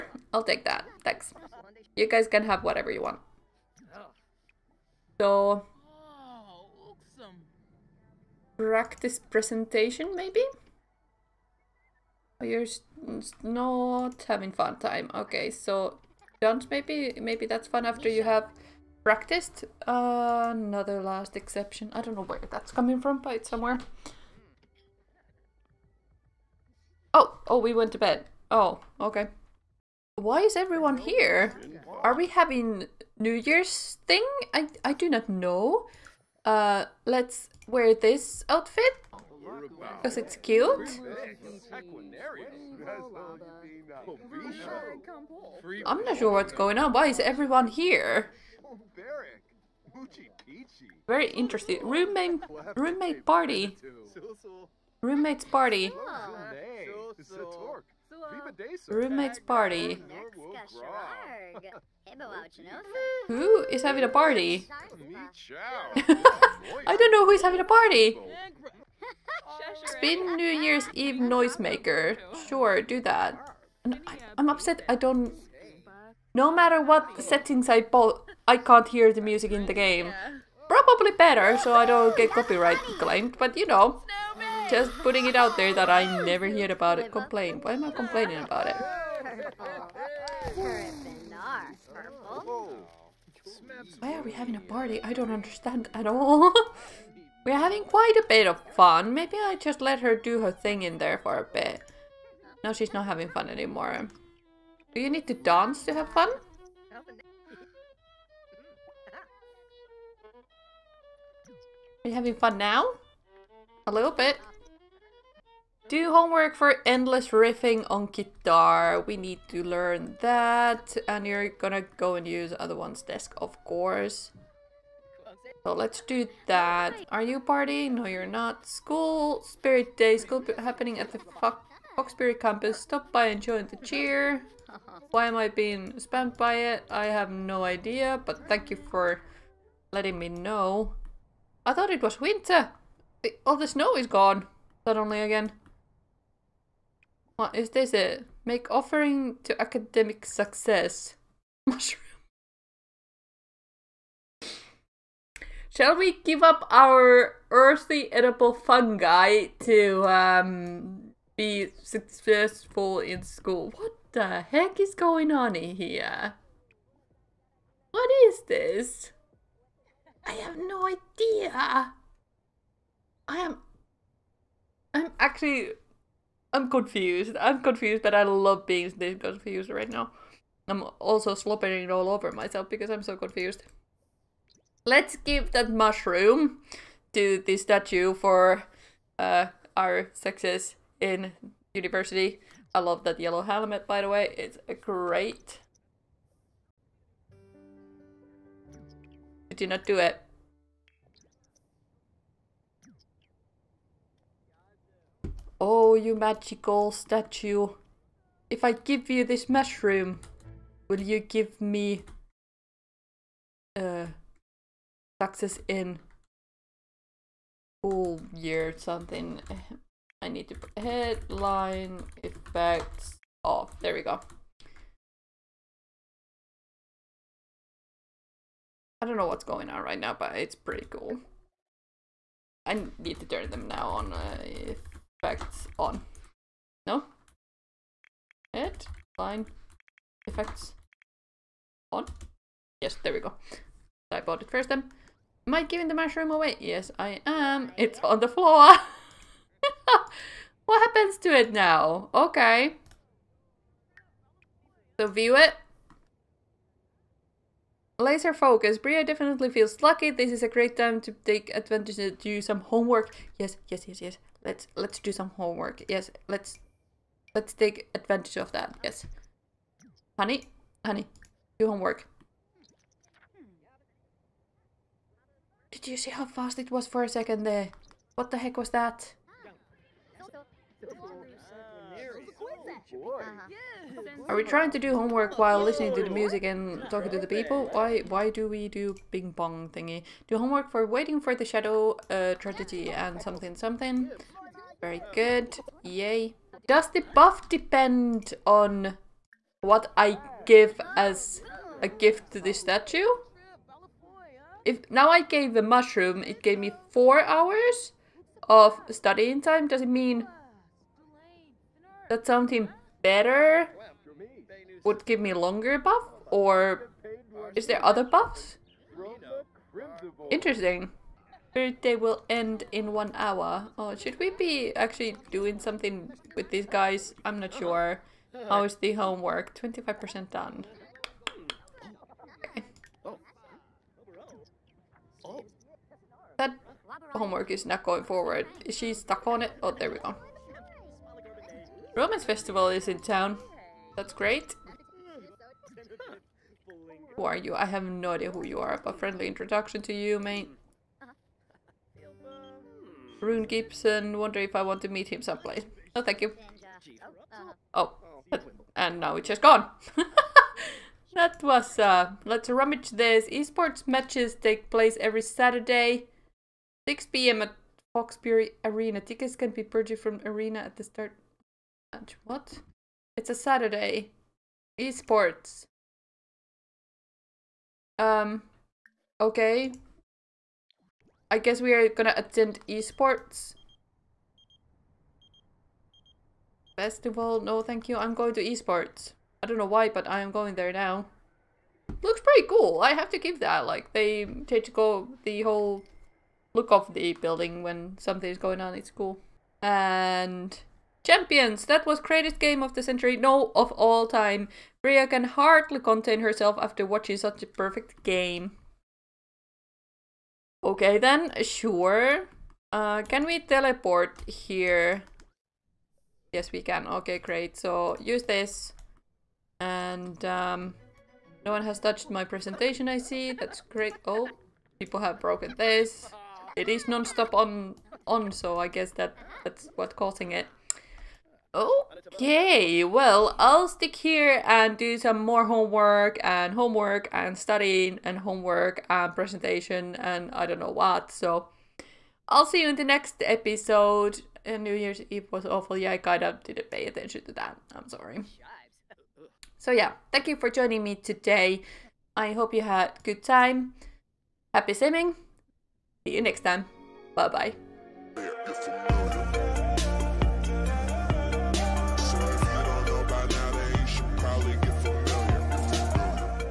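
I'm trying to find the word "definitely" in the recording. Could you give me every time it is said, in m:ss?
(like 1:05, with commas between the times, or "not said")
4:19.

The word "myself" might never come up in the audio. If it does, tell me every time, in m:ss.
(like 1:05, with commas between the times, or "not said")
3:02.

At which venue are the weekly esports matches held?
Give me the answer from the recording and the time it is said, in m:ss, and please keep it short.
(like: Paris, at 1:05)
Foxbury Arena, at 6:07.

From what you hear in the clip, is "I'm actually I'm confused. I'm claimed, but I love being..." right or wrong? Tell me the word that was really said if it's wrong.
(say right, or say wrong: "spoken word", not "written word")
wrong: "confused", not "claimed".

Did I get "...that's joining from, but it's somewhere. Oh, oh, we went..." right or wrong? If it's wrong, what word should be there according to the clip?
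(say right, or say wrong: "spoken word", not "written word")
wrong: "coming", not "joining".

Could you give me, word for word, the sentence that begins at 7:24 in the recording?
And uh, New Year's Eve was awful.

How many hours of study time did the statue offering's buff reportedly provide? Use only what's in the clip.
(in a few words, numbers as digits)
4.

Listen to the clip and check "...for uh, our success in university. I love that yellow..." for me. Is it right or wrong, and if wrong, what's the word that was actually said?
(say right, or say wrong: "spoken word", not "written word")
right.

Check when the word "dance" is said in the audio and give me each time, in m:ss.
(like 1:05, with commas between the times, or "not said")
1:45.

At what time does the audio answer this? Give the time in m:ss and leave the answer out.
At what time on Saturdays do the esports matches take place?
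6:06.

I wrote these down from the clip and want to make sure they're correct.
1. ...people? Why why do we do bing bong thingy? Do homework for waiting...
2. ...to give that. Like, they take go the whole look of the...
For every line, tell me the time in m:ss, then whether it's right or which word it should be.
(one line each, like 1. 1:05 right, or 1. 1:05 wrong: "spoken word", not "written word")
1. 4:47 right
2. 6:33 right.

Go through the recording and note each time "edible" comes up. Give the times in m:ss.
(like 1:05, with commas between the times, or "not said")
2:38.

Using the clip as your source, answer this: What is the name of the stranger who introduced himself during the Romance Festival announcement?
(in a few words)
Rune Gibson.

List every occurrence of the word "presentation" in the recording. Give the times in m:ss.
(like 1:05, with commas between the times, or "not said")
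0:09, 7:02, 7:19.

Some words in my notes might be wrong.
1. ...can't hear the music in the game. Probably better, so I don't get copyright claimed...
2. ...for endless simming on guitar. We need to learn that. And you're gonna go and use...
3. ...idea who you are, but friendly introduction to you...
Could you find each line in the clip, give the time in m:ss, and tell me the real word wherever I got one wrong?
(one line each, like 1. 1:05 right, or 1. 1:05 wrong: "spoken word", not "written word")
1. 1:18 right
2. 1:56 wrong: "riffing", not "simming"
3. 5:48 right.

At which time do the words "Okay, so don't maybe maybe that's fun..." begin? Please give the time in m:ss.
0:15.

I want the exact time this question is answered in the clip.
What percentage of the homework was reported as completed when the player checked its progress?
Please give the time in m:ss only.
5:29.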